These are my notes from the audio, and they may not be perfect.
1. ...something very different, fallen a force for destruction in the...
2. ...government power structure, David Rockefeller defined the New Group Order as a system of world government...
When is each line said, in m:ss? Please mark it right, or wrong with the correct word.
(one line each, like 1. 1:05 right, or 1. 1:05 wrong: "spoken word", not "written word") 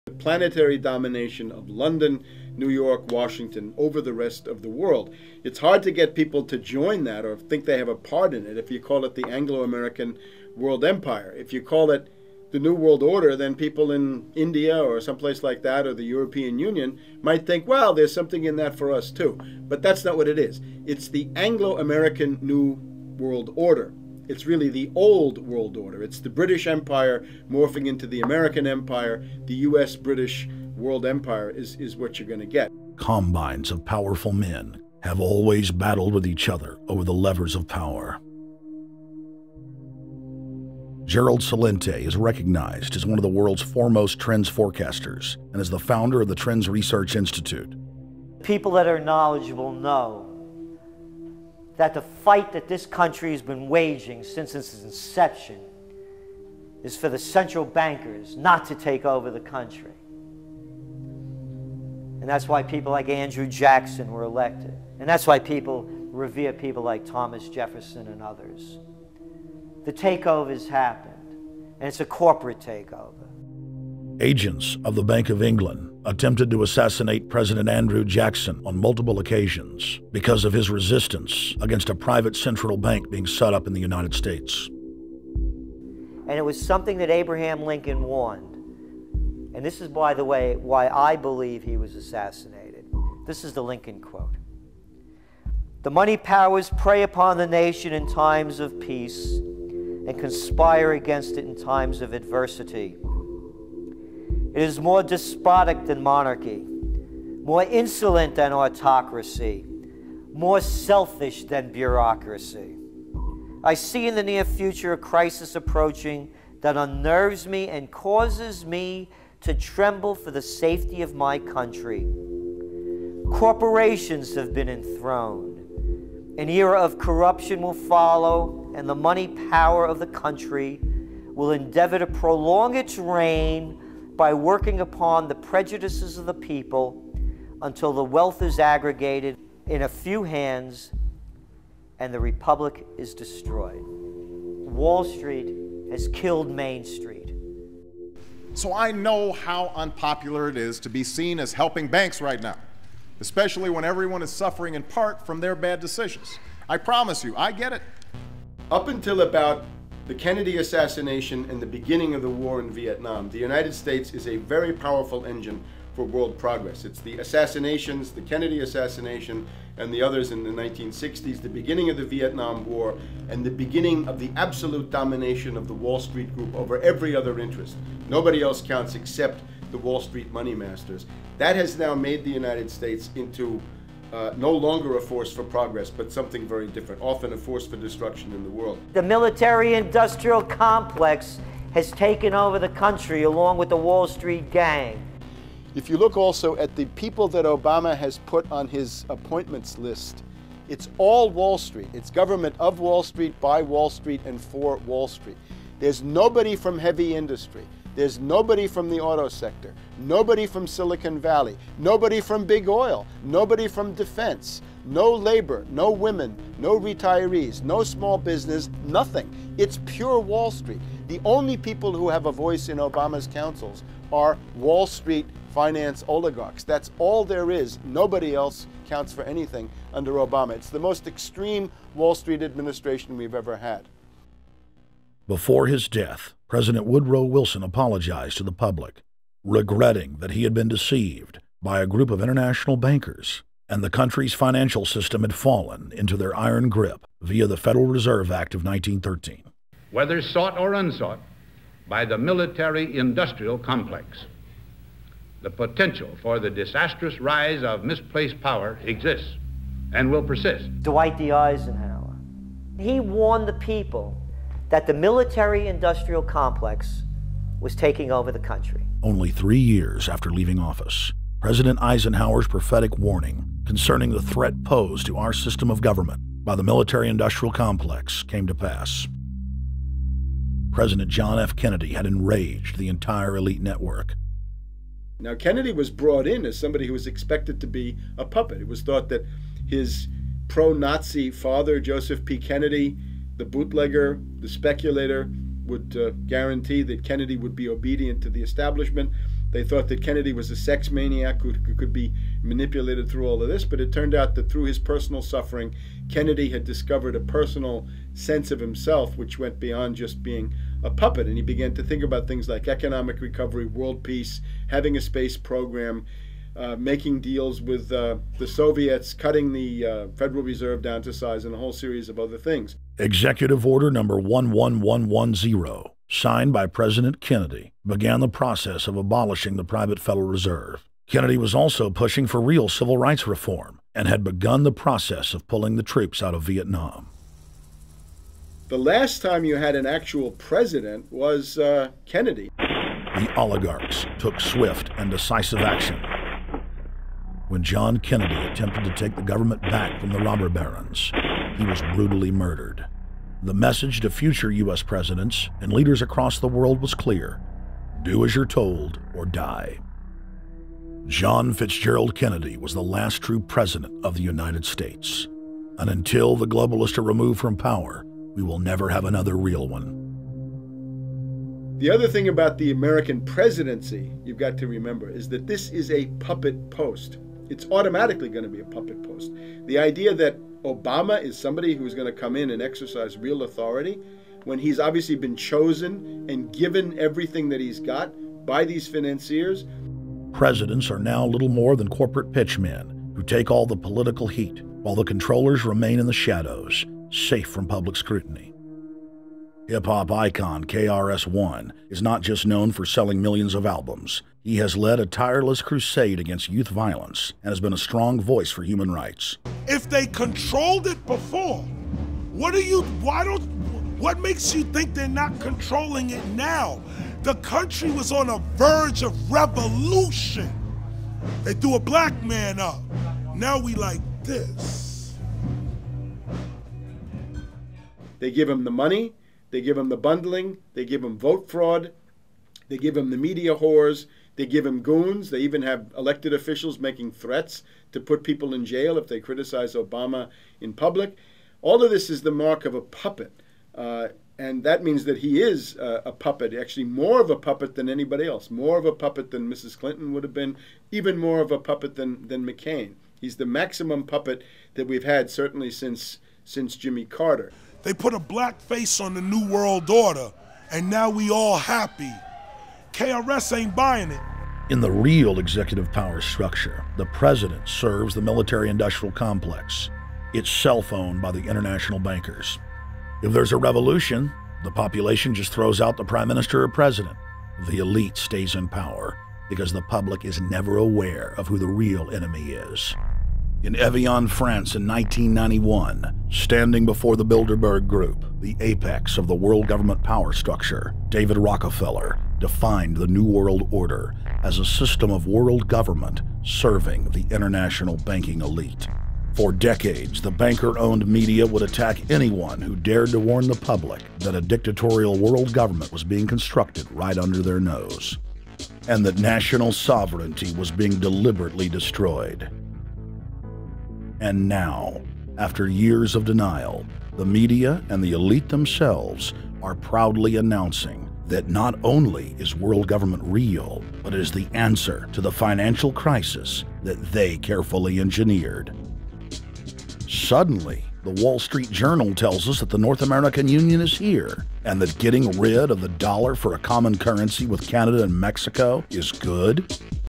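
1. 3:06 wrong: "often", not "fallen"
2. 8:09 wrong: "World", not "Group".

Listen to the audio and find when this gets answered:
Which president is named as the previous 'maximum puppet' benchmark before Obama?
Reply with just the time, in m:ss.
7:36.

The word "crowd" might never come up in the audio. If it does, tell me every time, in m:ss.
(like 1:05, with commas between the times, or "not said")
not said.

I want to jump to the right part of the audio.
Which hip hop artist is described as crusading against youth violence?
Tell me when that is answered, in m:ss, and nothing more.
6:40.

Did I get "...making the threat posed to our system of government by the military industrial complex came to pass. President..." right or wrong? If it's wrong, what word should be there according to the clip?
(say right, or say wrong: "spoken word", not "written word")
wrong: "concerning", not "making".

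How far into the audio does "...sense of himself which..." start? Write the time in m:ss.
5:08.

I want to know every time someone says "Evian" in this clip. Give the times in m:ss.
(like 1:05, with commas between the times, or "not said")
8:03.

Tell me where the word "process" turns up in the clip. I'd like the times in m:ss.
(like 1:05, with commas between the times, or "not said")
5:28, 5:34.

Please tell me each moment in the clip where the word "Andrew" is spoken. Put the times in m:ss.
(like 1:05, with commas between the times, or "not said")
1:03, 1:17.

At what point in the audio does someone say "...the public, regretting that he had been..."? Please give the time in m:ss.
3:58.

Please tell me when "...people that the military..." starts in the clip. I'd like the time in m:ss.
4:23.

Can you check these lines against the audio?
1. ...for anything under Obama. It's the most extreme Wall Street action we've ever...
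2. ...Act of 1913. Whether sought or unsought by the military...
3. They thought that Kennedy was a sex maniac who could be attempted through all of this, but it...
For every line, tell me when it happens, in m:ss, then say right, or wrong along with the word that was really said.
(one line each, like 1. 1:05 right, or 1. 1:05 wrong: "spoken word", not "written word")
1. 3:49 wrong: "administration", not "action"
2. 4:08 right
3. 4:59 wrong: "manipulated", not "attempted".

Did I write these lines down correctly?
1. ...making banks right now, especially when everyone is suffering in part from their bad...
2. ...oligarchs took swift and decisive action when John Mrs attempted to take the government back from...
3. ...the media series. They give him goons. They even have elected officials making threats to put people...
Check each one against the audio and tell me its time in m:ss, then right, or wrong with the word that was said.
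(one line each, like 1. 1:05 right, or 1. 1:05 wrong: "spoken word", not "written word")
1. 2:31 wrong: "helping", not "making"
2. 5:43 wrong: "Kennedy", not "Mrs"
3. 7:13 wrong: "whores", not "series".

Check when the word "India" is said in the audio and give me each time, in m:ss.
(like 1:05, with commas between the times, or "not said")
0:14.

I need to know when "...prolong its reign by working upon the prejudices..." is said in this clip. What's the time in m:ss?
2:12.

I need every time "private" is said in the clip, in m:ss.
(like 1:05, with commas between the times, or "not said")
1:21, 5:29.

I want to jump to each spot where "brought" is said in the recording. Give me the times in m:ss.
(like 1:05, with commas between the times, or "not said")
4:45.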